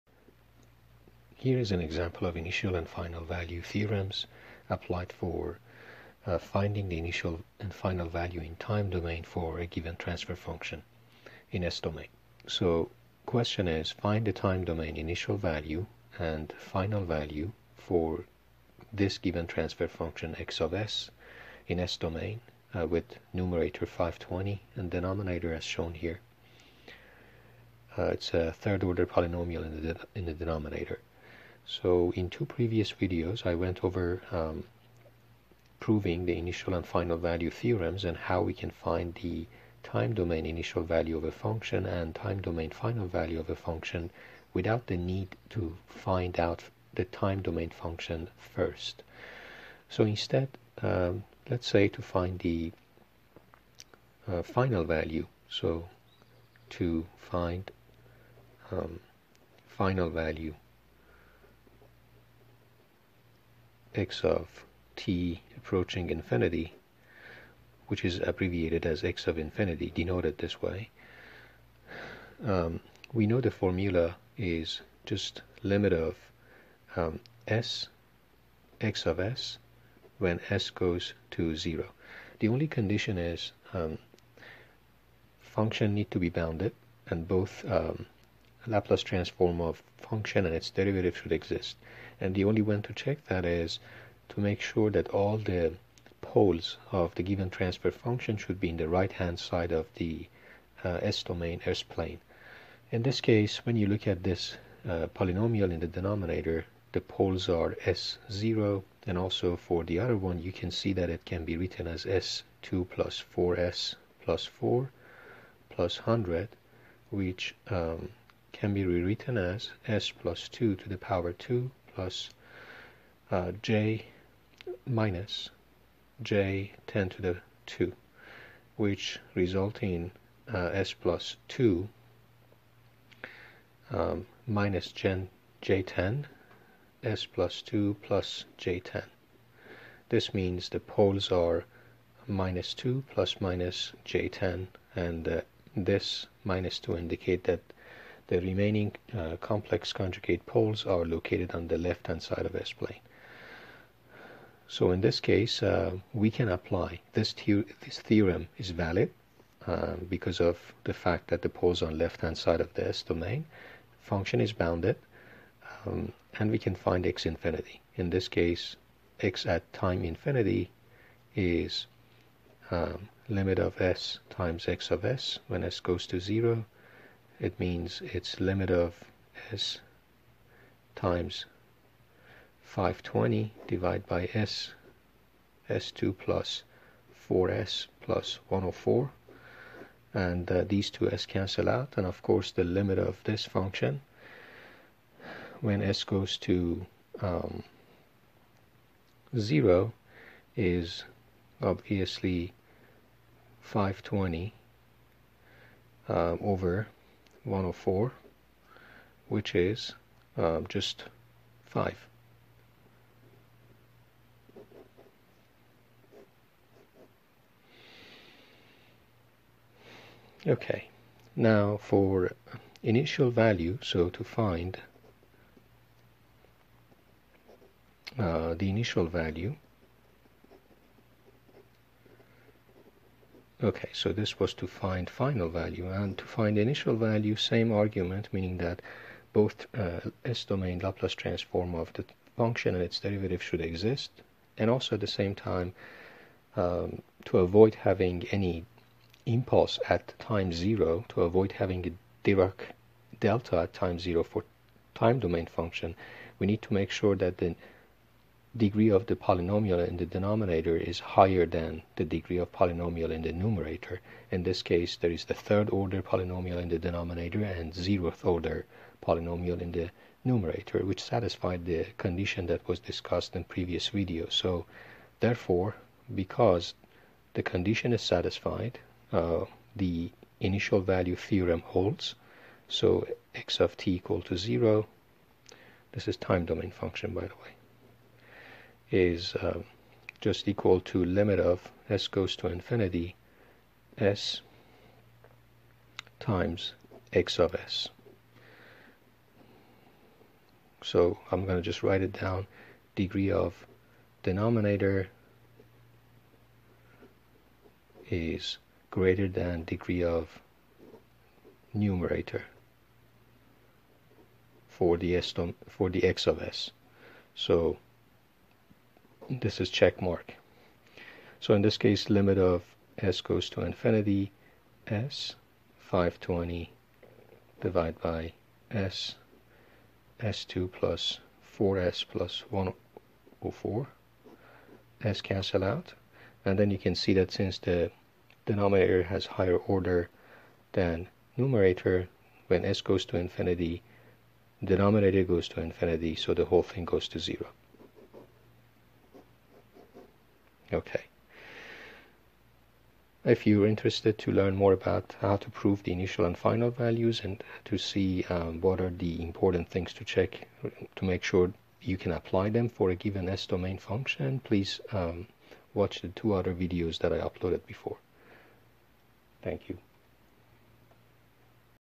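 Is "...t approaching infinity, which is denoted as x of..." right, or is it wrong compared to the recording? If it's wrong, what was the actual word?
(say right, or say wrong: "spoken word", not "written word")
wrong: "abbreviated", not "denoted".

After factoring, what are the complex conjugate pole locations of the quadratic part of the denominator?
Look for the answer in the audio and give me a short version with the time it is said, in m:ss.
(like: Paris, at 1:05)
-2 ± j10, at 2:22.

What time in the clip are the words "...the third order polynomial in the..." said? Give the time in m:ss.
4:25.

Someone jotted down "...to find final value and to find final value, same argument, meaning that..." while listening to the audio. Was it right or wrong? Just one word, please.
wrong.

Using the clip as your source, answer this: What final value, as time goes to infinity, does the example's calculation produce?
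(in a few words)
5.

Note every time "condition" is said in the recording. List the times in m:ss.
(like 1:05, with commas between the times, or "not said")
1:22, 4:31, 4:37.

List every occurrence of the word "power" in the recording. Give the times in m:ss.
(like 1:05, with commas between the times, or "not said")
2:00.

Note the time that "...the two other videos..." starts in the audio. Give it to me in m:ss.
6:06.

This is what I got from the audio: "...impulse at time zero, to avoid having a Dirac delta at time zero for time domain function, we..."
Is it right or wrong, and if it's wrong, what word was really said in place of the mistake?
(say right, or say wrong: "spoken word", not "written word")
right.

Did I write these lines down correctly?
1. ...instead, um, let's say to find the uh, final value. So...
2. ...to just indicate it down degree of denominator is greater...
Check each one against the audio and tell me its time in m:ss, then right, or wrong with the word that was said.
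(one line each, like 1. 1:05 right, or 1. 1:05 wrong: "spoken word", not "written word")
1. 0:50 right
2. 5:01 wrong: "write", not "indicate".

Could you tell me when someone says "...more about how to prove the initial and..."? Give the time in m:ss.
5:54.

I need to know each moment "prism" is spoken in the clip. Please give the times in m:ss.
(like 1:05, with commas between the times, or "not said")
not said.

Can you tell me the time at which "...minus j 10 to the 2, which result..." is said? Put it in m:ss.
2:04.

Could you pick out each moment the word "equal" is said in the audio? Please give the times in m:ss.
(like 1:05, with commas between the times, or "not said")
4:43, 4:50.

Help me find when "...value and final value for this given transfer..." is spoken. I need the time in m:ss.
0:15.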